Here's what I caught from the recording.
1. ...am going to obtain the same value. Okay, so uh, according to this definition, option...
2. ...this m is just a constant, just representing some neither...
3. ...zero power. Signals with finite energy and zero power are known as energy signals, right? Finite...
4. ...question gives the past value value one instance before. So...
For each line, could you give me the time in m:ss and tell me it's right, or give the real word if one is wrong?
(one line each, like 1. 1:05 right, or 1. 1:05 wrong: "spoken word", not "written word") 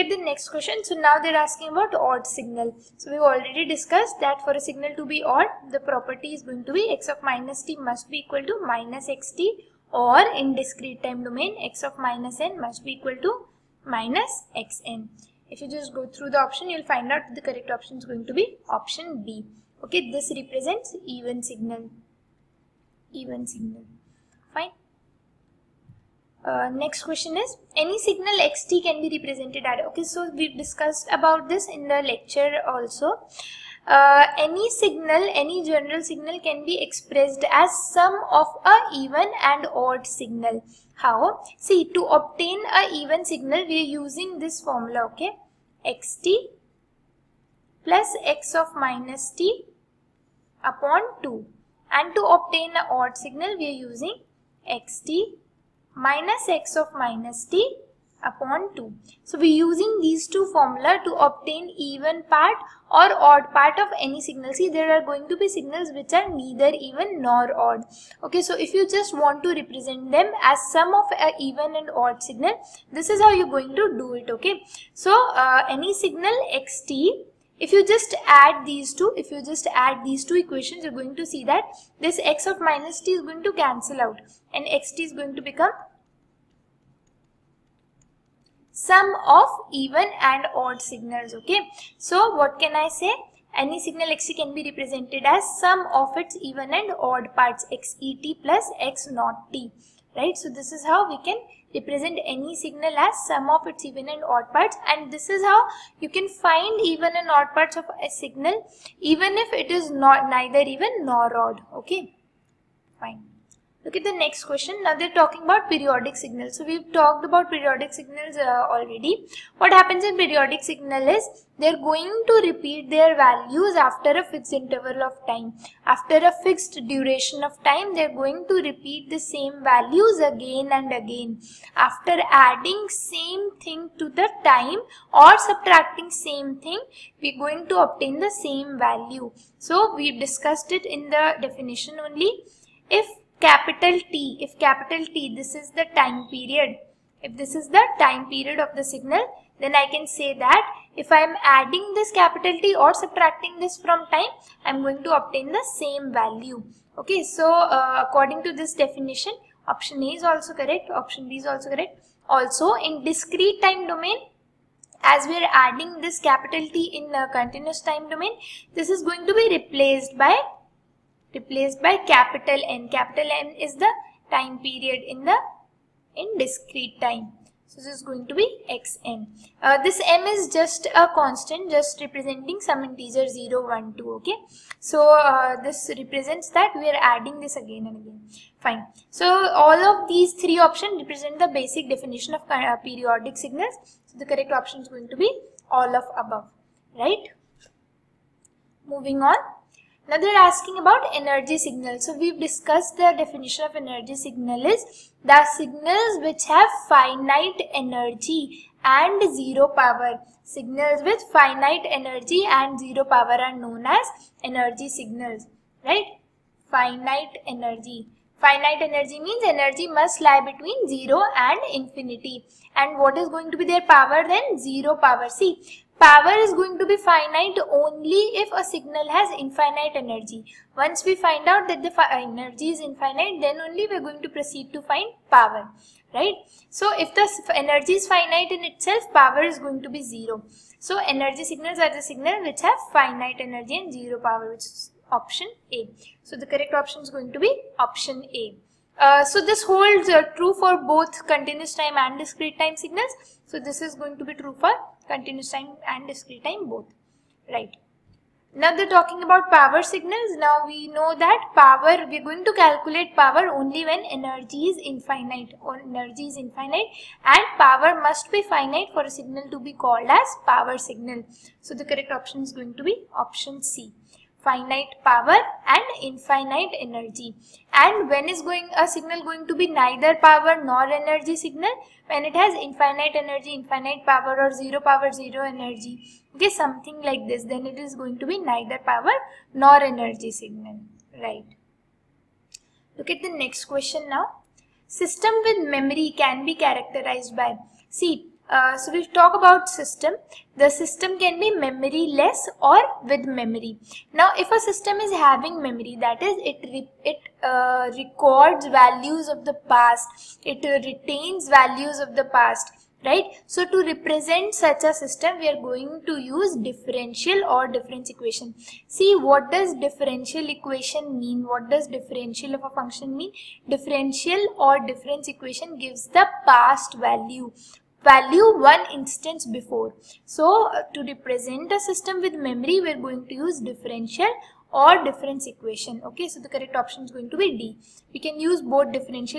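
1. 2:34 right
2. 2:59 wrong: "integer", not "neither"
3. 3:29 right
4. 5:25 wrong: "equation", not "question".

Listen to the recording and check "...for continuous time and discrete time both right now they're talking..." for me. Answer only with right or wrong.
right.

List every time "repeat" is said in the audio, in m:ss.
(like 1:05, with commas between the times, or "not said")
2:02, 2:08.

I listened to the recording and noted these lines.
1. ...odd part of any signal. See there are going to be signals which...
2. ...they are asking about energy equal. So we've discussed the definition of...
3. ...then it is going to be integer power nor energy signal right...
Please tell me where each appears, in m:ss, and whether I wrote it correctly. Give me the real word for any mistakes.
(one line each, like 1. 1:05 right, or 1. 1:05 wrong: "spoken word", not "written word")
1. 1:03 right
2. 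3:20 wrong: "signal", not "equal"
3. 4:47 wrong: "neither", not "integer".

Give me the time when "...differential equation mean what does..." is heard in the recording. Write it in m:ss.
5:19.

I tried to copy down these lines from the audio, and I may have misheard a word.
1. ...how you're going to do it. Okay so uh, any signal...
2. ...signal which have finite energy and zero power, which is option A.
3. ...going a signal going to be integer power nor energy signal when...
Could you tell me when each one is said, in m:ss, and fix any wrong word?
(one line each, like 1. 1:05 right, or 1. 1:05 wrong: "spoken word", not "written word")
1. 1:13 right
2. 4:02 right
3. 4:38 wrong: "neither", not "integer".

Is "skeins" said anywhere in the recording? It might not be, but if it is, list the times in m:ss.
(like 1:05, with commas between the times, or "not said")
not said.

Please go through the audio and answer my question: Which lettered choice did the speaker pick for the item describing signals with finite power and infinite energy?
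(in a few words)
Option C.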